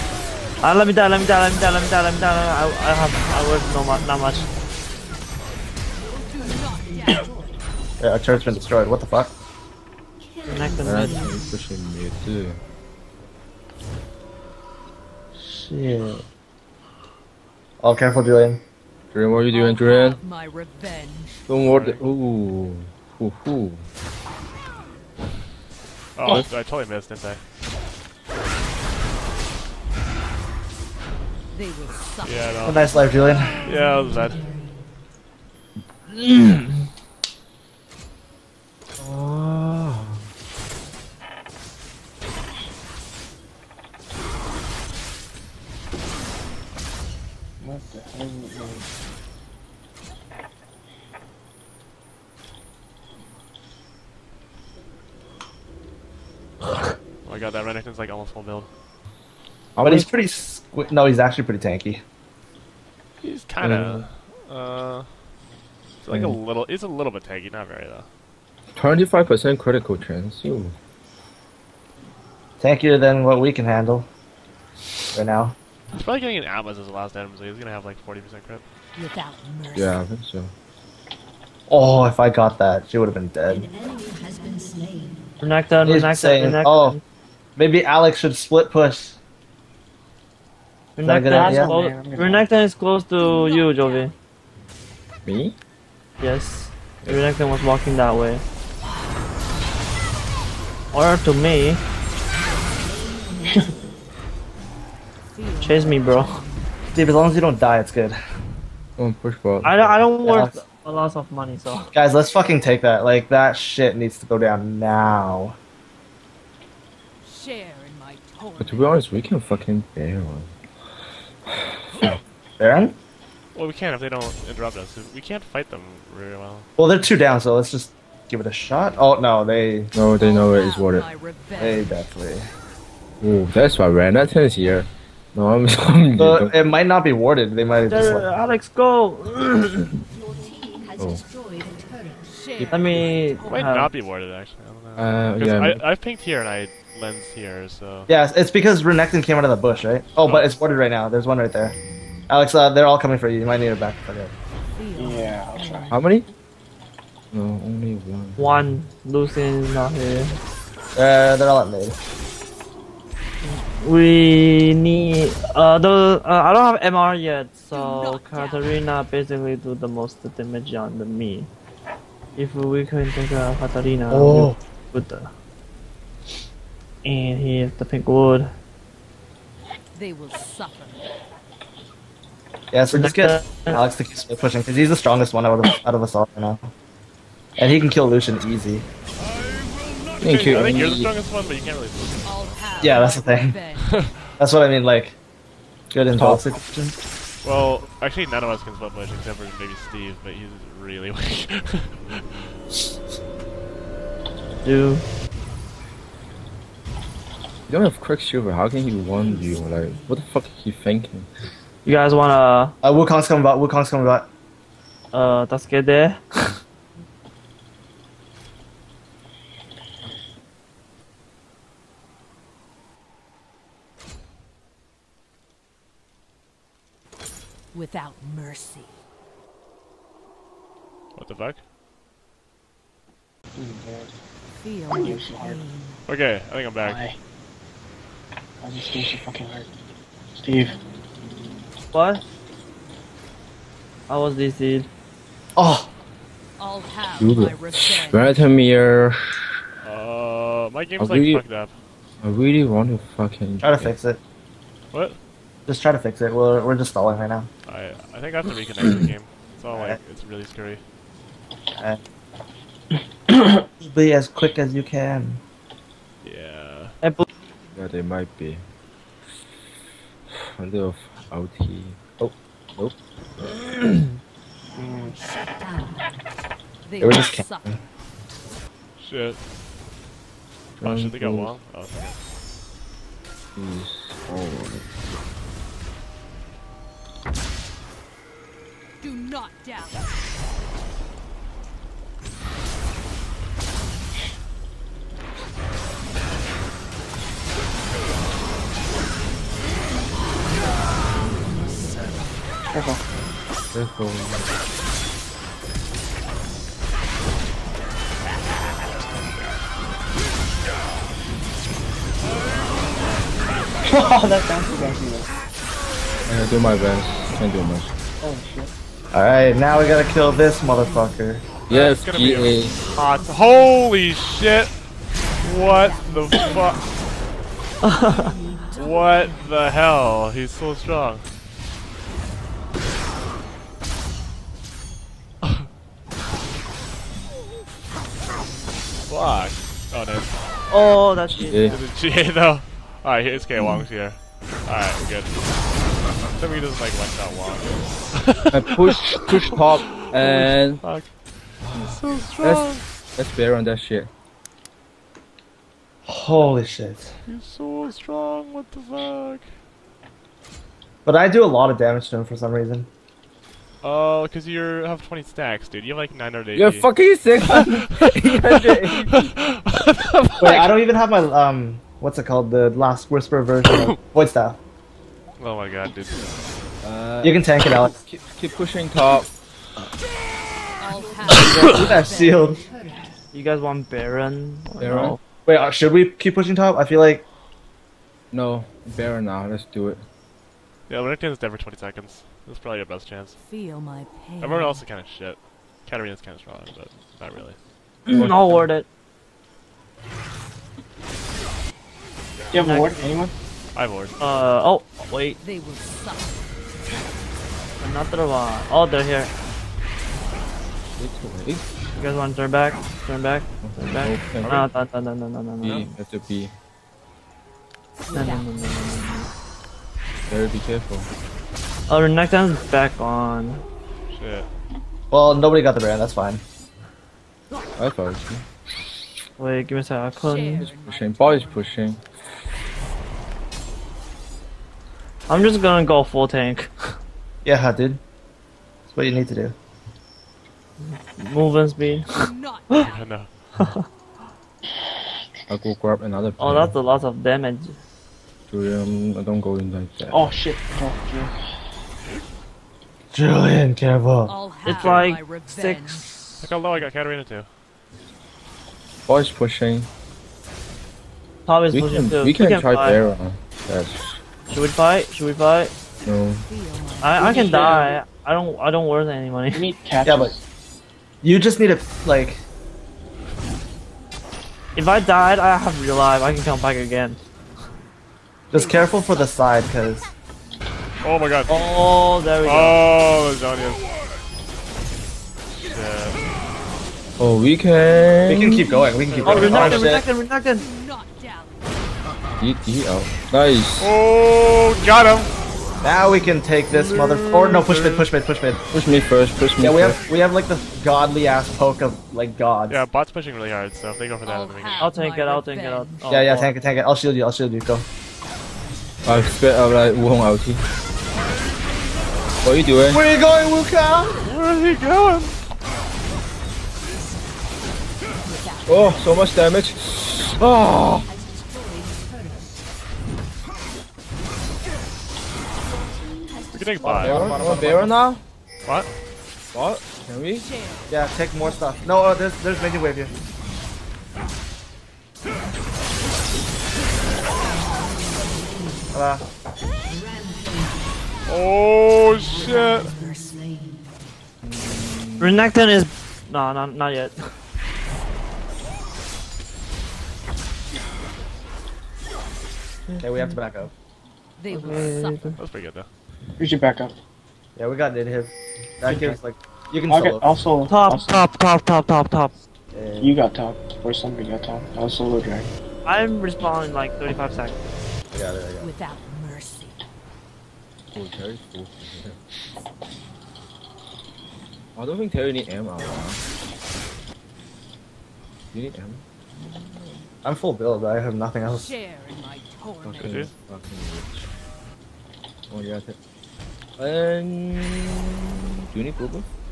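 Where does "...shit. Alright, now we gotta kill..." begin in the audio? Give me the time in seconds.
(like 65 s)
318 s.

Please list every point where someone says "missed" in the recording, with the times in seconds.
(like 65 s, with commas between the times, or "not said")
26 s.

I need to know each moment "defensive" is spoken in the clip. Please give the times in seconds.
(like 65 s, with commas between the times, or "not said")
not said.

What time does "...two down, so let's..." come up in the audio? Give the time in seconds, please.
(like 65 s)
126 s.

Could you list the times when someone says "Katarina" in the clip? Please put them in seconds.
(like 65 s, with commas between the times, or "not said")
168 s, 173 s, 395 s, 456 s.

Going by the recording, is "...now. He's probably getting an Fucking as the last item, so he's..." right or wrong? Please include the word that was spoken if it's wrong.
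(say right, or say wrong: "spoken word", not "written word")
wrong: "Atlas", not "Fucking".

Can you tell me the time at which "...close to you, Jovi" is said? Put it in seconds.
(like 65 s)
92 s.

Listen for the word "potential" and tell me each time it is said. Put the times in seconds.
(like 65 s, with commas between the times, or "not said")
not said.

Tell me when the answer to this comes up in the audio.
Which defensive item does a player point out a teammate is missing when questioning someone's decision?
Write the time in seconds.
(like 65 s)
207 s.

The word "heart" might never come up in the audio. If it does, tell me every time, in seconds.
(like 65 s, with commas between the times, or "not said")
239 s.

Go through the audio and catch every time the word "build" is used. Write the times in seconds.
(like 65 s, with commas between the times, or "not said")
58 s, 580 s.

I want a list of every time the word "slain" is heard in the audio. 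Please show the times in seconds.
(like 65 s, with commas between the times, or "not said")
84 s.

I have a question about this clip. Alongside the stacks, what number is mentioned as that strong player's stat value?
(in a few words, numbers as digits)
980.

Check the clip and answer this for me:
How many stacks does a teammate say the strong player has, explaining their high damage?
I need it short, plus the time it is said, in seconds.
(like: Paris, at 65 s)
20, at 365 s.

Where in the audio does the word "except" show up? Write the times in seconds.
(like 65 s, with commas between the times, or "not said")
199 s, 346 s.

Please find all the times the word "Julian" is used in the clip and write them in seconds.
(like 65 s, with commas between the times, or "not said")
18 s, 33 s, 448 s, 453 s.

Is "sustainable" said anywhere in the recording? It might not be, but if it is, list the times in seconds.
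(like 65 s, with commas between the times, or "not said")
not said.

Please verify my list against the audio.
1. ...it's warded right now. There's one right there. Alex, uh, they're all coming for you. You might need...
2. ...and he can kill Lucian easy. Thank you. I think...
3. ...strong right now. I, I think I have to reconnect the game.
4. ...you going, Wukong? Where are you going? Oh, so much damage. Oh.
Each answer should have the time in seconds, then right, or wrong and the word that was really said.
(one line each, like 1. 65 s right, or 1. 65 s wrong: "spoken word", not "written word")
1. 150 s right
2. 187 s right
3. 256 s wrong: "stalling", not "strong"
4. 513 s wrong: "Kang", not "Wukong".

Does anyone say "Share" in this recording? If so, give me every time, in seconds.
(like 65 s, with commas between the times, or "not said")
117 s, 581 s.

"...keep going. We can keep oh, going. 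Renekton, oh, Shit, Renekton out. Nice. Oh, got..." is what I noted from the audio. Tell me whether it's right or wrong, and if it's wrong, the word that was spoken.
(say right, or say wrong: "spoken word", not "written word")
wrong: "Renekton", not "Shit".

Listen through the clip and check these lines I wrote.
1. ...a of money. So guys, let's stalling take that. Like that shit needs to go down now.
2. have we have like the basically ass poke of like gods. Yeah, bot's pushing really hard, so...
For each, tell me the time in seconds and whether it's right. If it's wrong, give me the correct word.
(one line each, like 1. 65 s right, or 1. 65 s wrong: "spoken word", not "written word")
1. 110 s wrong: "fucking", not "stalling"
2. 499 s wrong: "godly", not "basically".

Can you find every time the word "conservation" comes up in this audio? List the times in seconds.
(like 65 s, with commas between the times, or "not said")
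not said.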